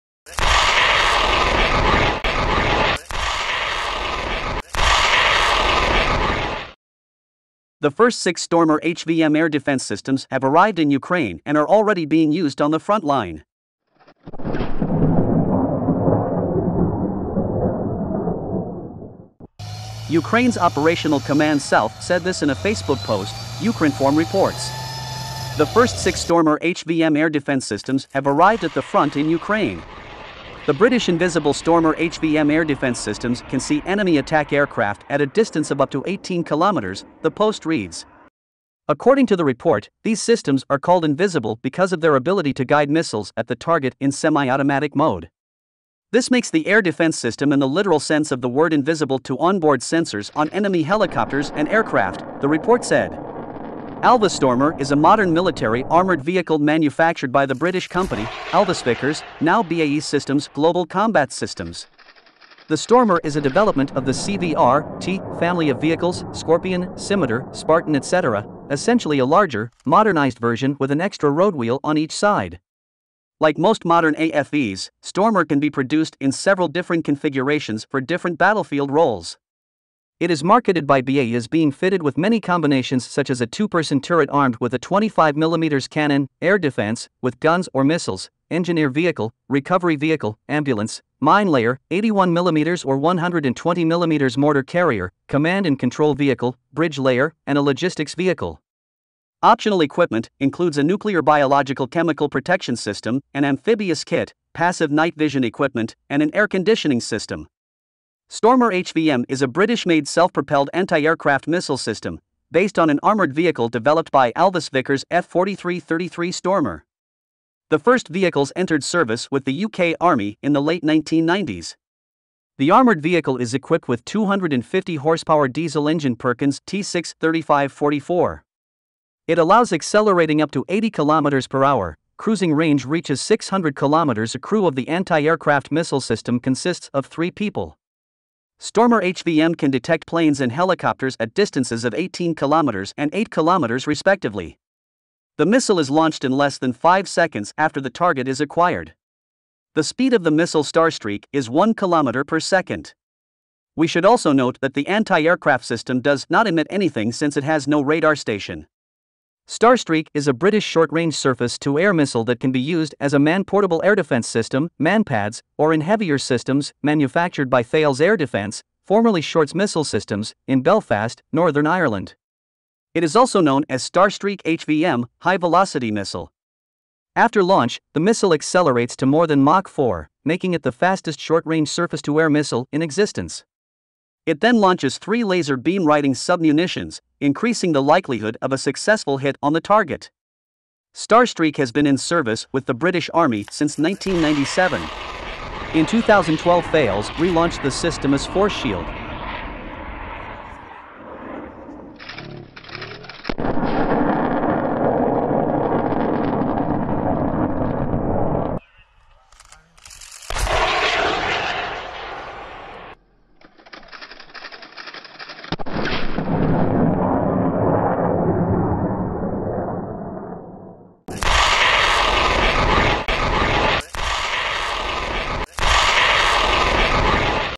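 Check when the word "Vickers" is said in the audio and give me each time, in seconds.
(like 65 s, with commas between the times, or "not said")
58 s, 114 s.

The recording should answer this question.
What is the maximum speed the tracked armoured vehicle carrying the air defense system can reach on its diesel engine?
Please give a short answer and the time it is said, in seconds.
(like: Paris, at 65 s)
80 km per hour, at 130 s.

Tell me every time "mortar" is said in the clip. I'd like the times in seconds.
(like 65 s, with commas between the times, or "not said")
94 s.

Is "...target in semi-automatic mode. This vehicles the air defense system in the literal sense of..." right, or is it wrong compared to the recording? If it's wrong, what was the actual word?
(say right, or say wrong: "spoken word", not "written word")
wrong: "makes", not "vehicles".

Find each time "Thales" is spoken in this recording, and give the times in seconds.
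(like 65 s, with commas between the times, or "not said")
167 s, 196 s.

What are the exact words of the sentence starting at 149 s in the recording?
The speed of the missile Starstreak is 1 kilometer per second.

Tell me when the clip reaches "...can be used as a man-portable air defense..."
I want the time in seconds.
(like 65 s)
162 s.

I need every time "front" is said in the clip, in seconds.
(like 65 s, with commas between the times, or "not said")
12 s, 28 s.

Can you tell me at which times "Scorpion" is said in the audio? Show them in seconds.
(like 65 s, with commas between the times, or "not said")
66 s.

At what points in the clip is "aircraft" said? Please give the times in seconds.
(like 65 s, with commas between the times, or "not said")
34 s, 51 s, 110 s, 135 s, 154 s.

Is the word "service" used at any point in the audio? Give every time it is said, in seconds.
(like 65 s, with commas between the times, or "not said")
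118 s, 191 s.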